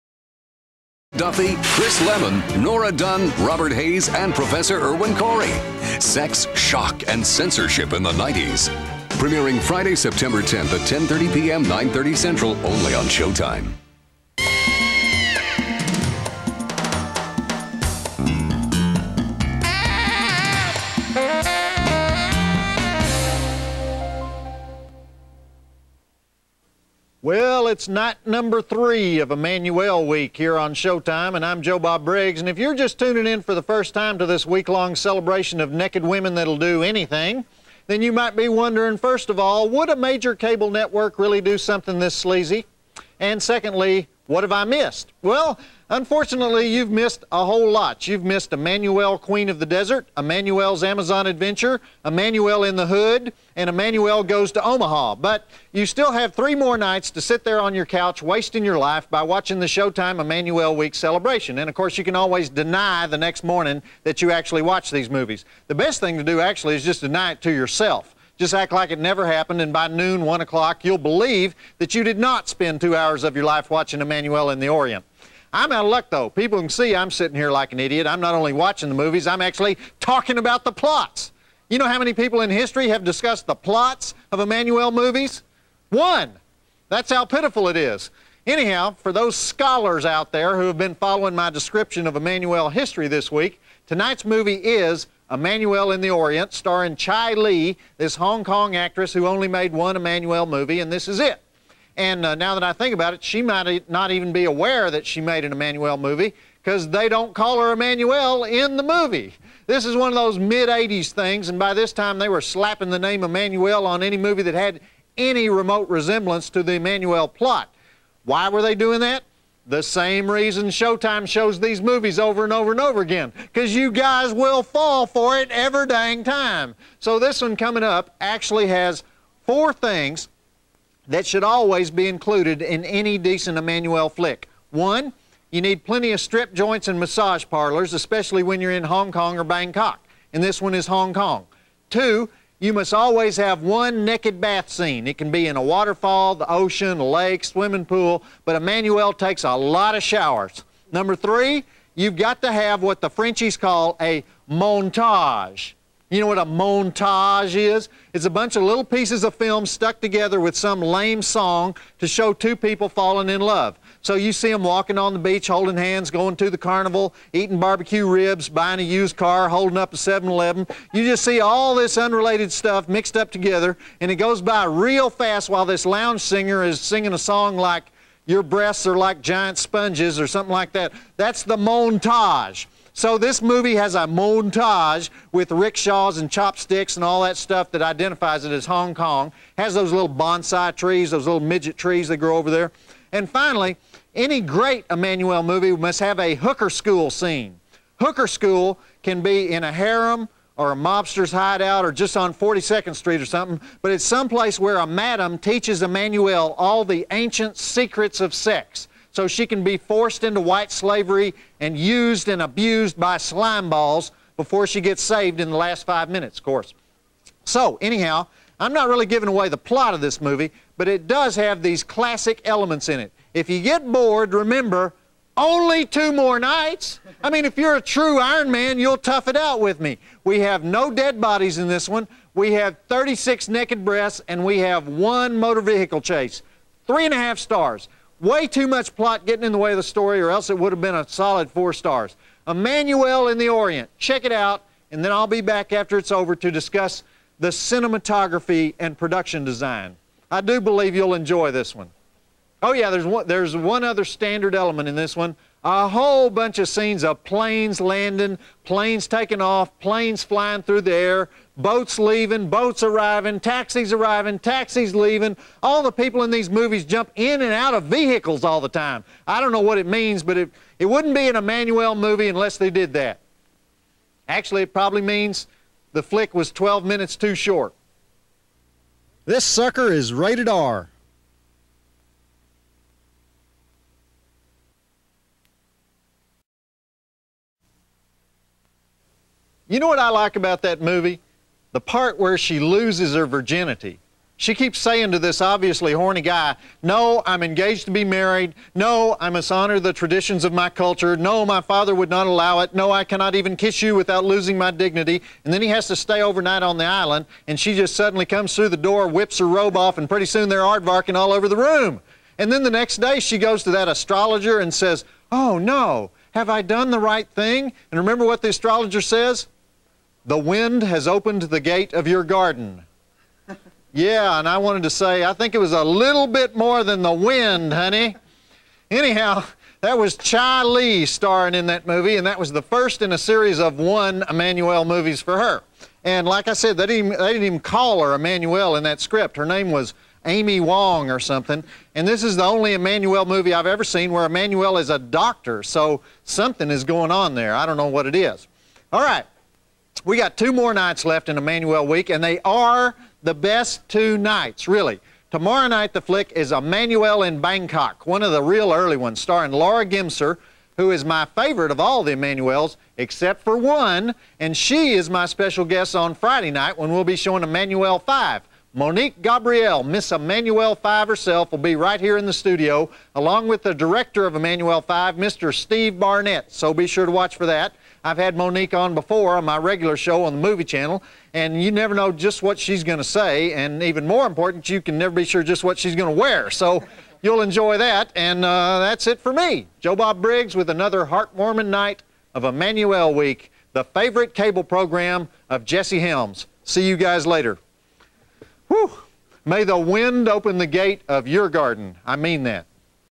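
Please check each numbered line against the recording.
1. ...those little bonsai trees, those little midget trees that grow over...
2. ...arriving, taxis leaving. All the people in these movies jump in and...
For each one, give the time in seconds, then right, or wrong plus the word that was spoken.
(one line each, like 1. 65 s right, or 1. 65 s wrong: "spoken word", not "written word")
1. 189 s right
2. 263 s right.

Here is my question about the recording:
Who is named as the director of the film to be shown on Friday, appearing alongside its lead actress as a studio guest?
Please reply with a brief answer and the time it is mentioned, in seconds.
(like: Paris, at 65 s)
Steve Barnett, at 375 s.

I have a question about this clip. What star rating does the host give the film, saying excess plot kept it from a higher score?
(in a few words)
3.5 stars.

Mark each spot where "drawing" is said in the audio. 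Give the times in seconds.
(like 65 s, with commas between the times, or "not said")
not said.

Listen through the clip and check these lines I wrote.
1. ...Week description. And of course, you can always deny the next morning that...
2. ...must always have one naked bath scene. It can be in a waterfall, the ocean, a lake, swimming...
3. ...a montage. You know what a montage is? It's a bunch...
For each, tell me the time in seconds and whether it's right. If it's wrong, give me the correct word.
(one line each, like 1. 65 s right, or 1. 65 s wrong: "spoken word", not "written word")
1. 60 s wrong: "celebration", not "description"
2. 142 s right
3. 153 s right.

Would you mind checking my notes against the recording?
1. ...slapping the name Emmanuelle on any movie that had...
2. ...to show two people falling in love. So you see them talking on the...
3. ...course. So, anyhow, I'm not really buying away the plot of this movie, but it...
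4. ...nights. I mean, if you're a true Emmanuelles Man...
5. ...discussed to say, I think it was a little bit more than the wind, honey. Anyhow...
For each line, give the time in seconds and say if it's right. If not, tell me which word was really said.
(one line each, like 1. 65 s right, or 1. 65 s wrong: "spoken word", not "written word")
1. 112 s right
2. 161 s wrong: "walking", not "talking"
3. 216 s wrong: "giving", not "buying"
4. 226 s wrong: "Iron", not "Emmanuelles"
5. 324 s wrong: "wanted", not "discussed".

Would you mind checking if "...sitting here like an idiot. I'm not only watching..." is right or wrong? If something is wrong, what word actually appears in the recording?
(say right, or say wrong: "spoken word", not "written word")
right.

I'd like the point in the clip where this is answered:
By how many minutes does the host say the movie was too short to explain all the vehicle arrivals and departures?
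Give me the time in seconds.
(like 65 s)
276 s.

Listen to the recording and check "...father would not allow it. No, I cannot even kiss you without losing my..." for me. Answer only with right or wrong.
right.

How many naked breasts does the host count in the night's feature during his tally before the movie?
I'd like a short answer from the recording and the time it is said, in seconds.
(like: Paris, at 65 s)
36, at 232 s.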